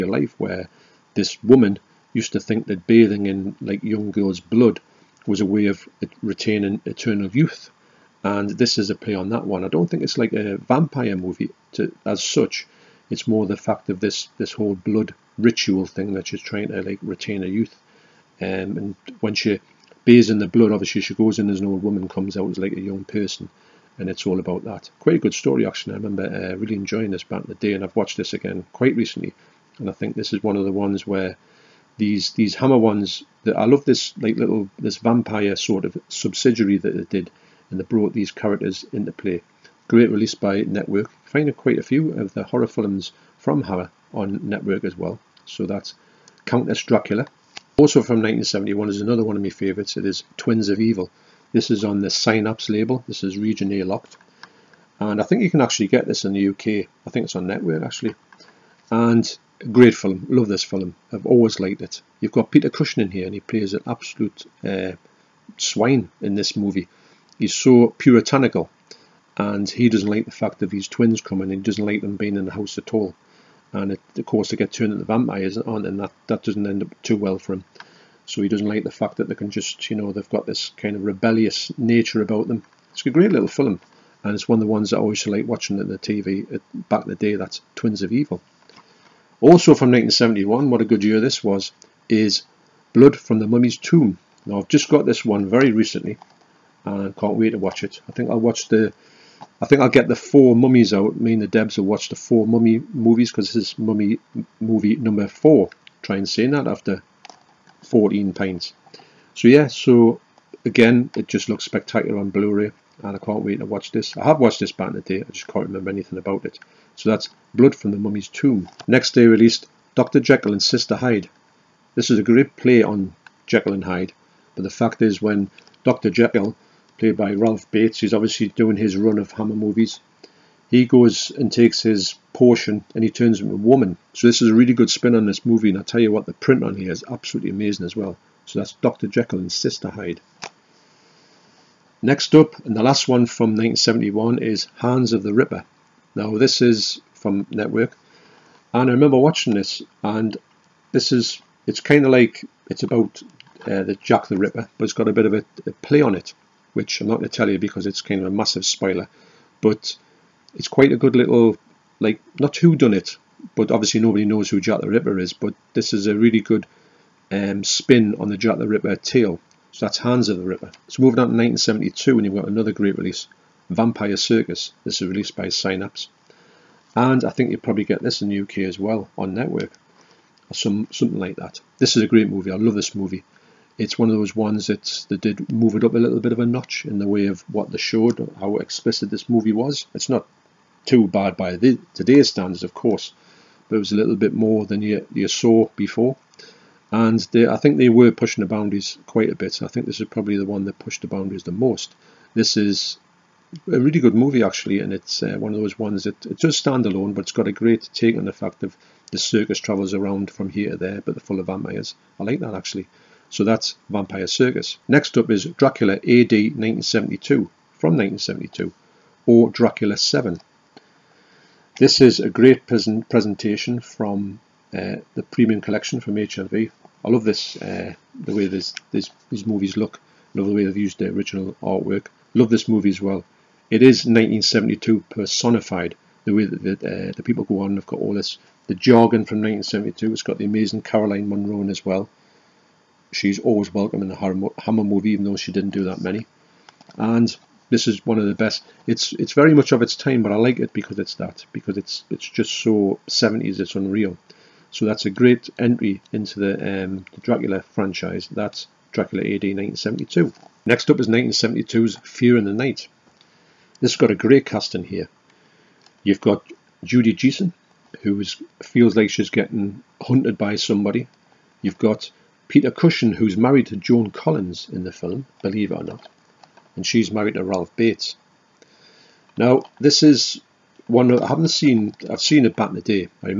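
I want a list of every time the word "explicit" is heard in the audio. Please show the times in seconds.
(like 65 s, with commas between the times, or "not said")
188 s.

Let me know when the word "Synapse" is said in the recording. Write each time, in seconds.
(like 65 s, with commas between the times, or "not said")
52 s, 175 s.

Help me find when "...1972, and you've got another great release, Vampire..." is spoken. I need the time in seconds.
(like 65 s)
171 s.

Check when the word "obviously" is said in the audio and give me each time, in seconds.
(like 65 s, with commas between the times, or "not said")
20 s, 128 s, 163 s.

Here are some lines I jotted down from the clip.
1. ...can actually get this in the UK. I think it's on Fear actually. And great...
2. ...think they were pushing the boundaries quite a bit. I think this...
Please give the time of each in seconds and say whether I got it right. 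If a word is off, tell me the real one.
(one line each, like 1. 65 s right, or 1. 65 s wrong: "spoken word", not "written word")
1. 55 s wrong: "Network", not "Fear"
2. 197 s right.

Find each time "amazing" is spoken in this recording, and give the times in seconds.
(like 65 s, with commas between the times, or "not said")
137 s, 240 s.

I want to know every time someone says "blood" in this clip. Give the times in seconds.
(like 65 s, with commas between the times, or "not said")
4 s, 14 s, 20 s, 92 s, 117 s.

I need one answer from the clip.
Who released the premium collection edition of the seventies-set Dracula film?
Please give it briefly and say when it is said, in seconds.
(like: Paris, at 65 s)
HMV, at 226 s.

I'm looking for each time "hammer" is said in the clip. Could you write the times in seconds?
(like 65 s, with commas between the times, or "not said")
32 s, 43 s, 129 s, 244 s.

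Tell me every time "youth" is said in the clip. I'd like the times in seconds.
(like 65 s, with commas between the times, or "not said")
7 s, 17 s.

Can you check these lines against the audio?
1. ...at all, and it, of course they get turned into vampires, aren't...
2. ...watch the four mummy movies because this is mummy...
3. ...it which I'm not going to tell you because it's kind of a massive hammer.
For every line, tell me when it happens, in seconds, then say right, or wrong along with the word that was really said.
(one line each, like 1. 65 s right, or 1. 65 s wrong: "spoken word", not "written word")
1. 72 s right
2. 101 s right
3. 156 s wrong: "spoiler", not "hammer".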